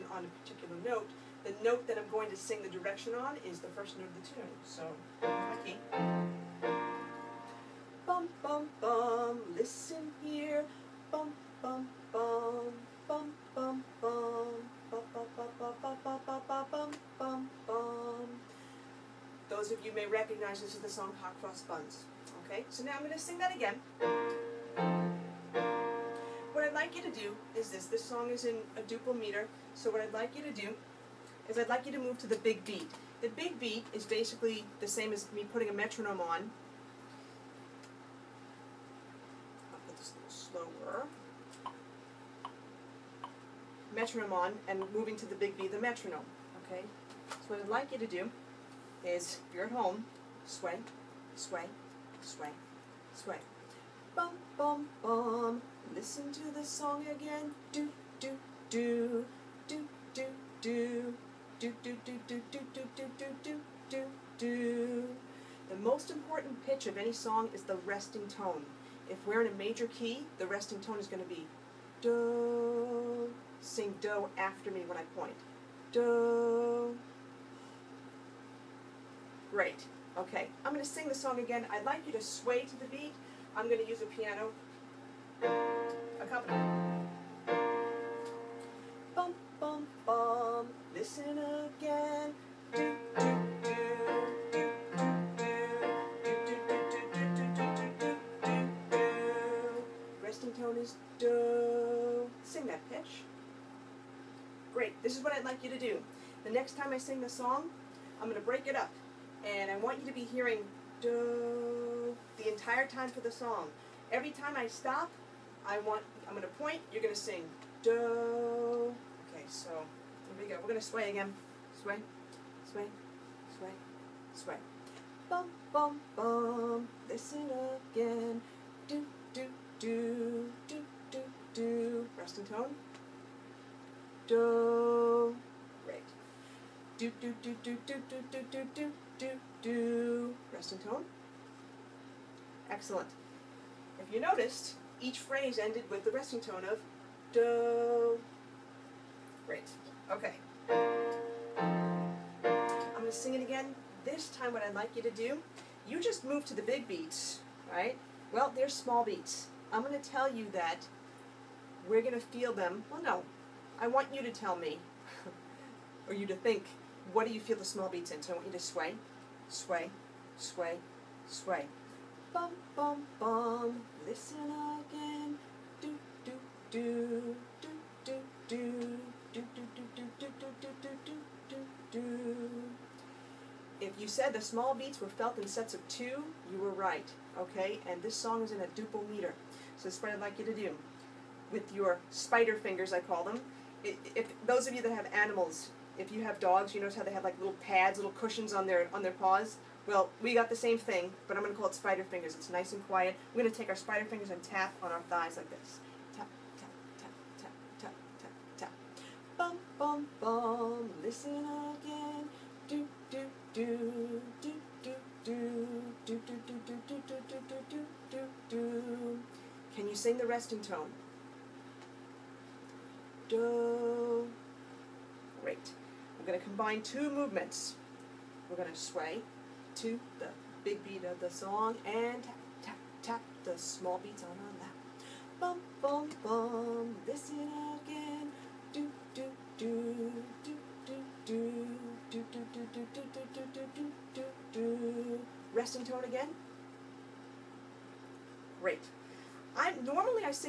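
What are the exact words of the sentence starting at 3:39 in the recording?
Can you sing the resting tone?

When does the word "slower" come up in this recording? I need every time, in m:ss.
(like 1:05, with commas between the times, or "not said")
0:40.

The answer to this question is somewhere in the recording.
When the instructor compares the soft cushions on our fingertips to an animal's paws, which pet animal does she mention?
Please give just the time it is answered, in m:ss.
3:16.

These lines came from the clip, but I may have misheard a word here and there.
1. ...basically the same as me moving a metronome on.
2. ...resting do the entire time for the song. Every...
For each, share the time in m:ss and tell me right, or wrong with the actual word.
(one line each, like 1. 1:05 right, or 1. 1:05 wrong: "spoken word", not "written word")
1. 0:34 wrong: "putting", not "moving"
2. 1:50 wrong: "hearing", not "resting".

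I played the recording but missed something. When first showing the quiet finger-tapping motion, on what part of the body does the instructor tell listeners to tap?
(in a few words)
thighs.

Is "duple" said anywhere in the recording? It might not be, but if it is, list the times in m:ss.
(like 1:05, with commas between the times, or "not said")
0:28, 3:08.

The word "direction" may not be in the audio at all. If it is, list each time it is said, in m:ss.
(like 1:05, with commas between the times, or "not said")
0:02.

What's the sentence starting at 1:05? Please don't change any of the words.
The most important pitch of any song is the resting tone.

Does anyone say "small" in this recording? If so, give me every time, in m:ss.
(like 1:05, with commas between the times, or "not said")
2:38, 2:47, 3:04, 3:53.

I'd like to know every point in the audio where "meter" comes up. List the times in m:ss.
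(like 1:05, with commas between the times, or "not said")
0:29, 3:09.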